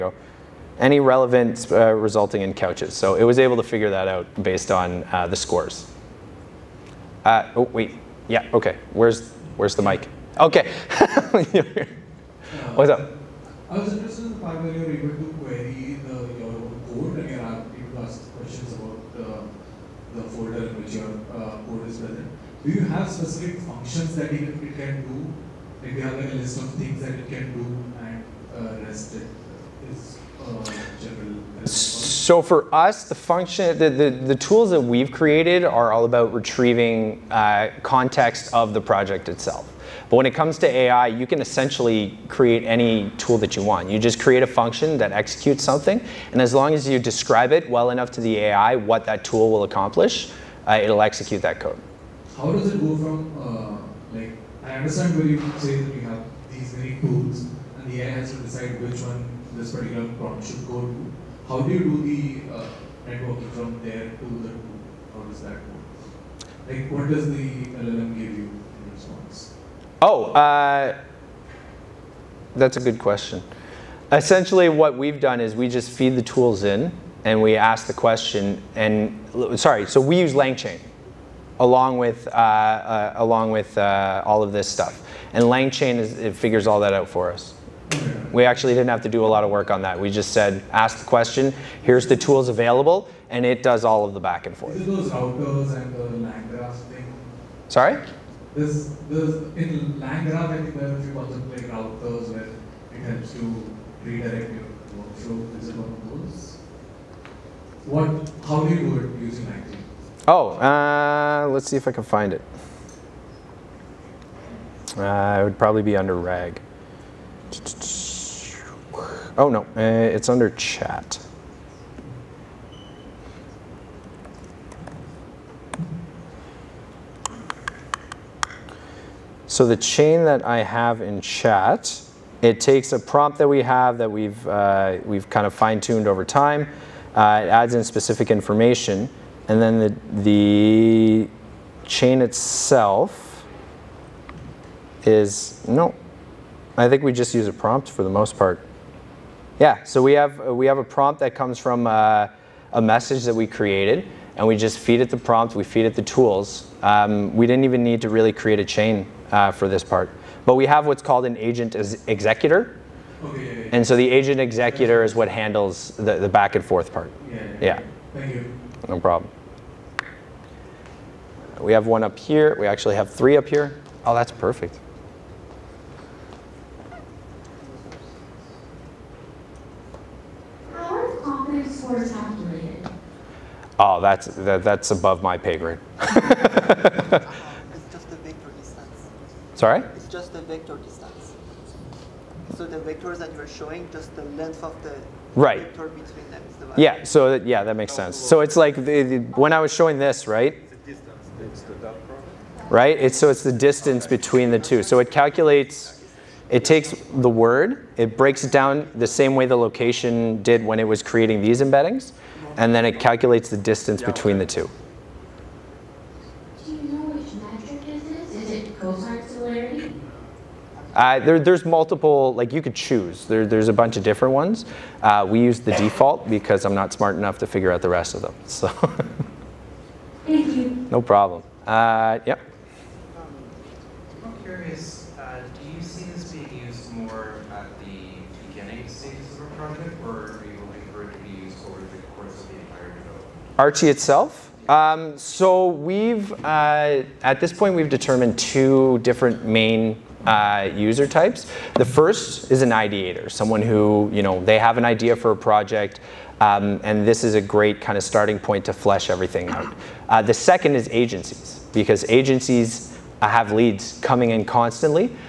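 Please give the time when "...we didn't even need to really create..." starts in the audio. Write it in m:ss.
2:37.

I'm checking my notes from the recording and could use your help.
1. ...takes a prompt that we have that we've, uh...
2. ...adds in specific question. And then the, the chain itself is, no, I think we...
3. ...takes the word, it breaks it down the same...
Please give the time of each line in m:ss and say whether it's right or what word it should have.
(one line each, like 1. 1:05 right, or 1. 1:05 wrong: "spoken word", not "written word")
1. 2:12 right
2. 2:17 wrong: "information", not "question"
3. 3:26 right.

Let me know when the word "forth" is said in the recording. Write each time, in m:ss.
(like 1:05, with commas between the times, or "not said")
1:34, 2:46.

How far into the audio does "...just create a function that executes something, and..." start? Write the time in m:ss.
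0:43.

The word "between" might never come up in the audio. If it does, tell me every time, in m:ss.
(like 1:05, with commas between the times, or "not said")
3:15, 3:24, 3:34.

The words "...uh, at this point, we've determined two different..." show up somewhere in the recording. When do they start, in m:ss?
4:06.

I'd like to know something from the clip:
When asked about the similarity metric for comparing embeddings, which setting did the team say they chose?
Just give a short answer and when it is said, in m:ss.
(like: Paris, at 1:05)
the default, at 3:45.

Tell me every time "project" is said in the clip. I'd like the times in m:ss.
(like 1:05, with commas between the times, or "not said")
0:38, 4:15.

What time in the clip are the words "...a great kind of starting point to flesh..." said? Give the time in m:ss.
4:17.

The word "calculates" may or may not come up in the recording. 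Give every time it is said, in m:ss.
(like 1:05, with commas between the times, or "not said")
3:25, 3:32.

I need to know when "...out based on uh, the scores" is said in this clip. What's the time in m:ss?
0:04.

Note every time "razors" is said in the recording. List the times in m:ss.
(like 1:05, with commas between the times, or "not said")
not said.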